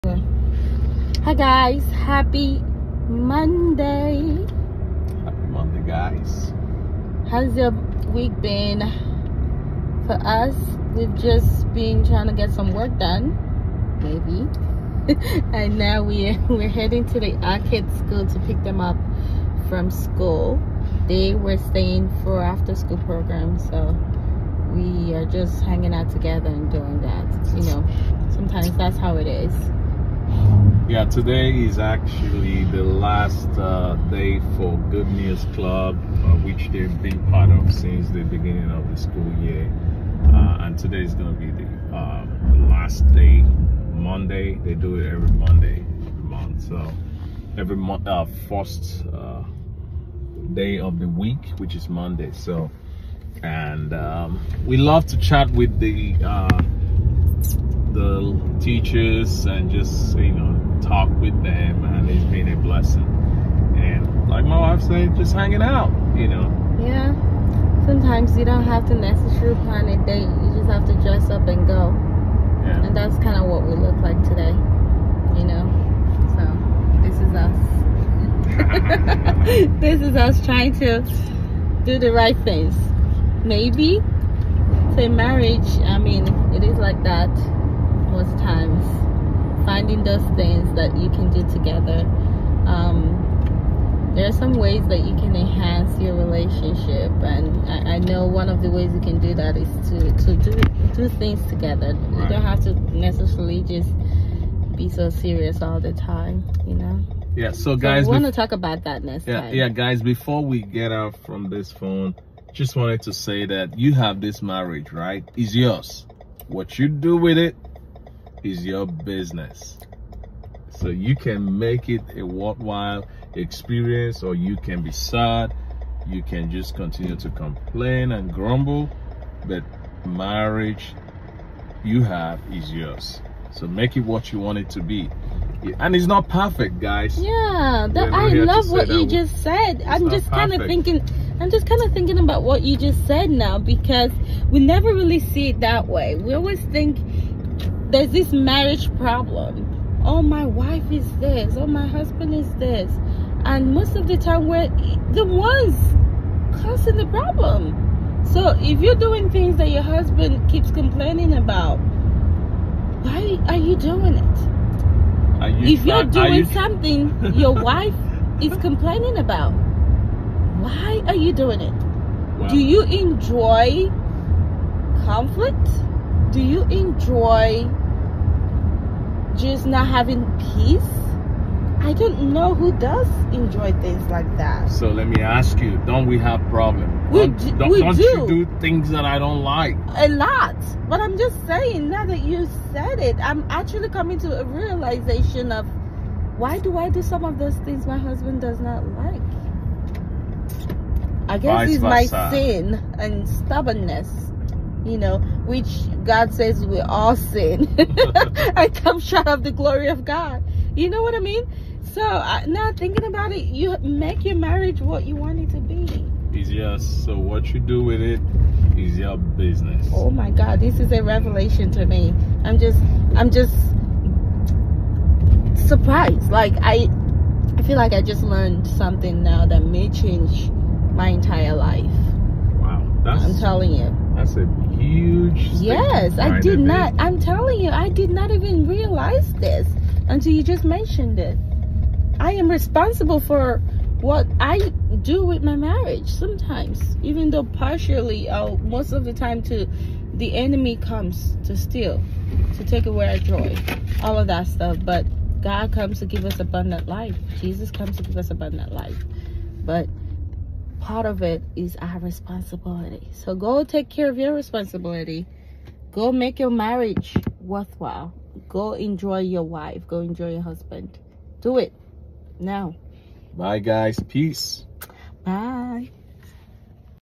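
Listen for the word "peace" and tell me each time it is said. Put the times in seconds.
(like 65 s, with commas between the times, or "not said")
180 s, 274 s.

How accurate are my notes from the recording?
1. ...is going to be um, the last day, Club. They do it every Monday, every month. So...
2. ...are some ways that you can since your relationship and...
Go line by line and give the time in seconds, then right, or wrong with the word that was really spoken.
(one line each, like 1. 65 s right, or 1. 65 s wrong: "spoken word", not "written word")
1. 41 s wrong: "Monday", not "Club"
2. 94 s wrong: "enhance", not "since".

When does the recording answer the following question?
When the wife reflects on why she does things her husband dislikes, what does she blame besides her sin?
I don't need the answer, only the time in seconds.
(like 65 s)
203 s.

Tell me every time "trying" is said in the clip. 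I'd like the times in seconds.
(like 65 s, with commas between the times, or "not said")
12 s, 80 s.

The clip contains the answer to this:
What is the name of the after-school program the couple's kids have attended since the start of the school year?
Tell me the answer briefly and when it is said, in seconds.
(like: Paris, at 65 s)
Good News Club, at 34 s.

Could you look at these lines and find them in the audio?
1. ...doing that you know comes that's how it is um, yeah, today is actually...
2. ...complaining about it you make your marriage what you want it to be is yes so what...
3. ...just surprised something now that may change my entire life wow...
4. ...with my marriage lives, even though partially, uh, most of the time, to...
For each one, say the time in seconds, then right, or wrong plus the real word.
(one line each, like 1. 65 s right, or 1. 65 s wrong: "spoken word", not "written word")
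1. 26 s wrong: "sometimes", not "comes"
2. 212 s wrong: "thinking", not "complaining"
3. 228 s wrong: "learned", not "surprised"
4. 245 s wrong: "sometimes", not "lives".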